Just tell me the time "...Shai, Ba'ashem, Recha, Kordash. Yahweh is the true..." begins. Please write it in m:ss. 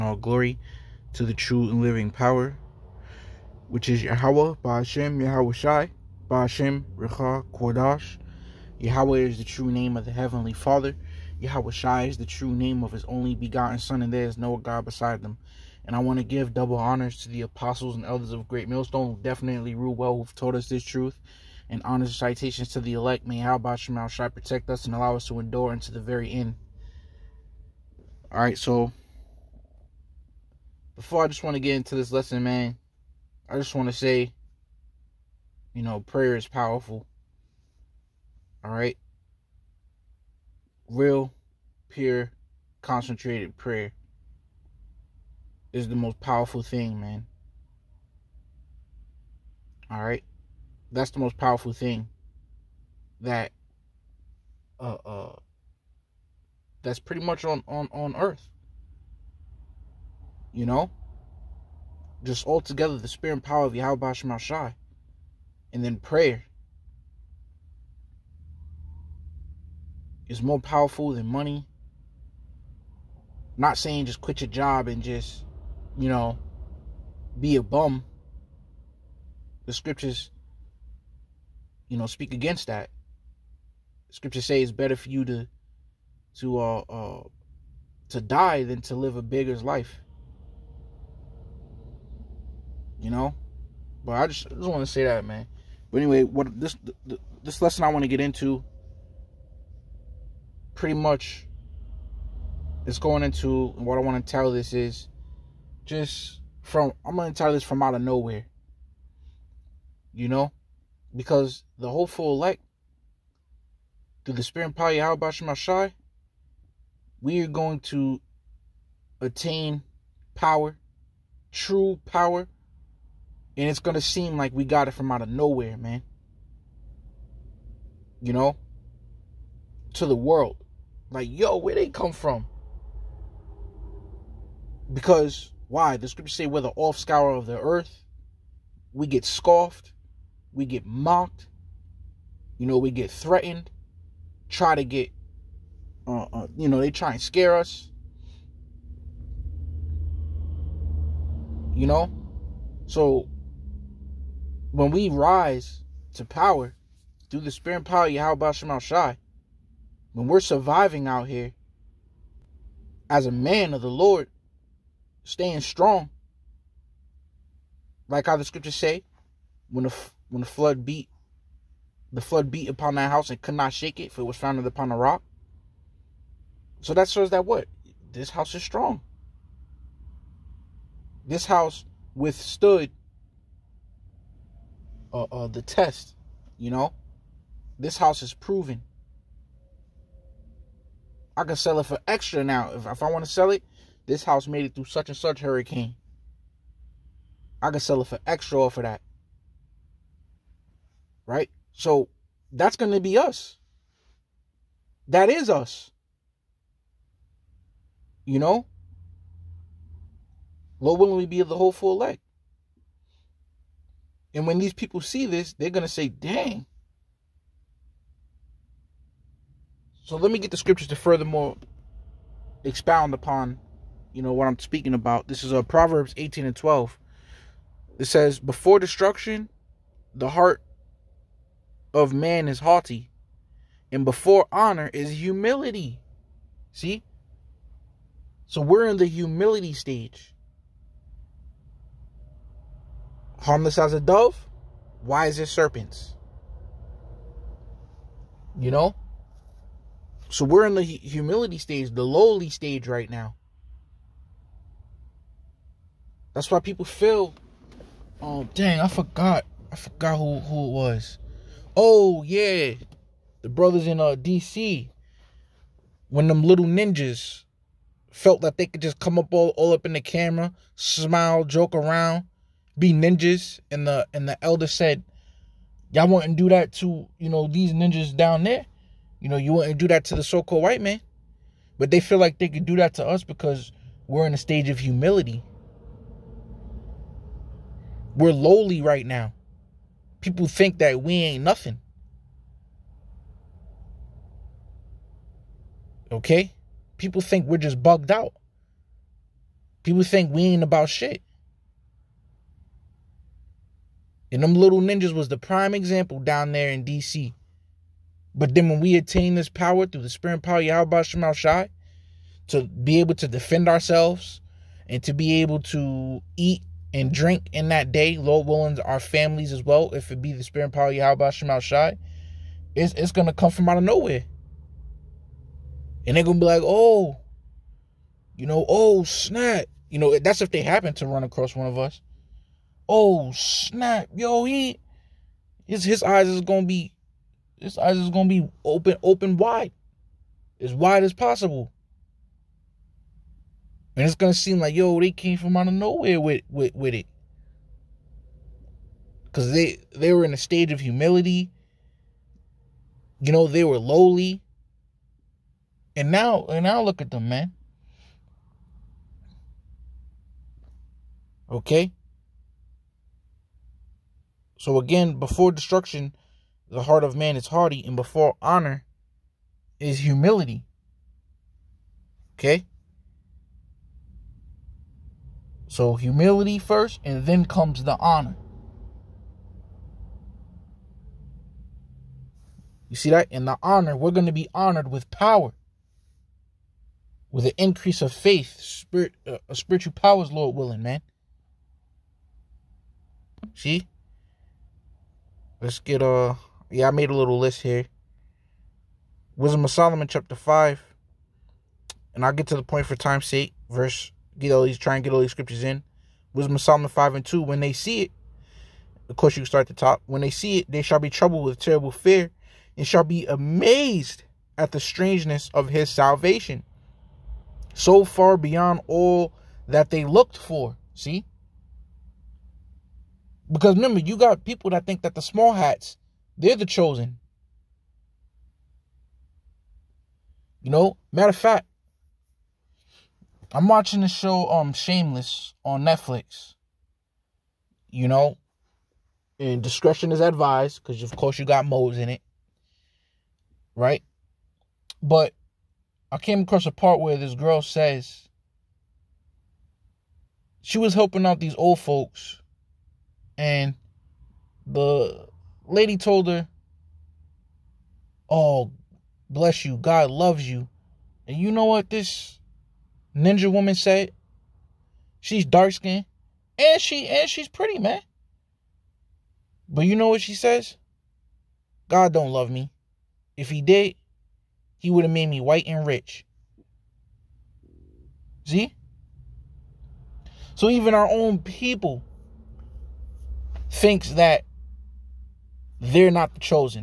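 0:05.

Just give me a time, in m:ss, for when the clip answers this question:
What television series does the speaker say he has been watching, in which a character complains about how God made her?
7:14.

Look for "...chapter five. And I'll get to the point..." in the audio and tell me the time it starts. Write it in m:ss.
6:40.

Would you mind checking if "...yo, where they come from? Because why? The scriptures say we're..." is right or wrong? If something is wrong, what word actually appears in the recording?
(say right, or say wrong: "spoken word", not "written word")
right.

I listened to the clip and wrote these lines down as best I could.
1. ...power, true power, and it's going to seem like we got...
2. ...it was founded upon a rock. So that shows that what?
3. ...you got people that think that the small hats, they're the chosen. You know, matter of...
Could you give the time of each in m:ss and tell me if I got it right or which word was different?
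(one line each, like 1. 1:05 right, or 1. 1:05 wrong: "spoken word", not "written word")
1. 2:00 right
2. 2:54 right
3. 7:03 right.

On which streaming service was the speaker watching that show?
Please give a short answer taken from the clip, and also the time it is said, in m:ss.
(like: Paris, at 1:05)
Netflix, at 7:15.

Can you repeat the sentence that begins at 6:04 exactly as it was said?
So again, before destruction, the heart of man is haughty, and before honor is humility.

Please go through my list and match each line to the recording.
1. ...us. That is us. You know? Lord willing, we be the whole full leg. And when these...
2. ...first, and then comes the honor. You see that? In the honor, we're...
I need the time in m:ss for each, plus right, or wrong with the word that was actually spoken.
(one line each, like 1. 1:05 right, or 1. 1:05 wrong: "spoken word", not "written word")
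1. 3:23 right
2. 6:16 right.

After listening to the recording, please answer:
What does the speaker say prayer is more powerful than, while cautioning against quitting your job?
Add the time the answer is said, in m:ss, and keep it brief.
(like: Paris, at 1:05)
money, at 1:11.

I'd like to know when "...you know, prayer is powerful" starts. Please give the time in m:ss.
0:35.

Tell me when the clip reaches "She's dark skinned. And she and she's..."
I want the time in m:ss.
7:45.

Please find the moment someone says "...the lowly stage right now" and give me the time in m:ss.
4:11.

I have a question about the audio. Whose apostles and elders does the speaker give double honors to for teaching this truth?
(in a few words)
Great Millstone.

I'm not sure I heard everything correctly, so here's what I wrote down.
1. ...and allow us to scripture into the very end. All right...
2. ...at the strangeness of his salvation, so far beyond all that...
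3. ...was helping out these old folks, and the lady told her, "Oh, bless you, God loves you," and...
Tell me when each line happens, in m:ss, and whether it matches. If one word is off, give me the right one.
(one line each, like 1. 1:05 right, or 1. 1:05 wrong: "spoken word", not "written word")
1. 0:24 wrong: "endure", not "scripture"
2. 6:54 right
3. 7:30 right.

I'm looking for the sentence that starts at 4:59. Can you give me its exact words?
People think we ain't about shit.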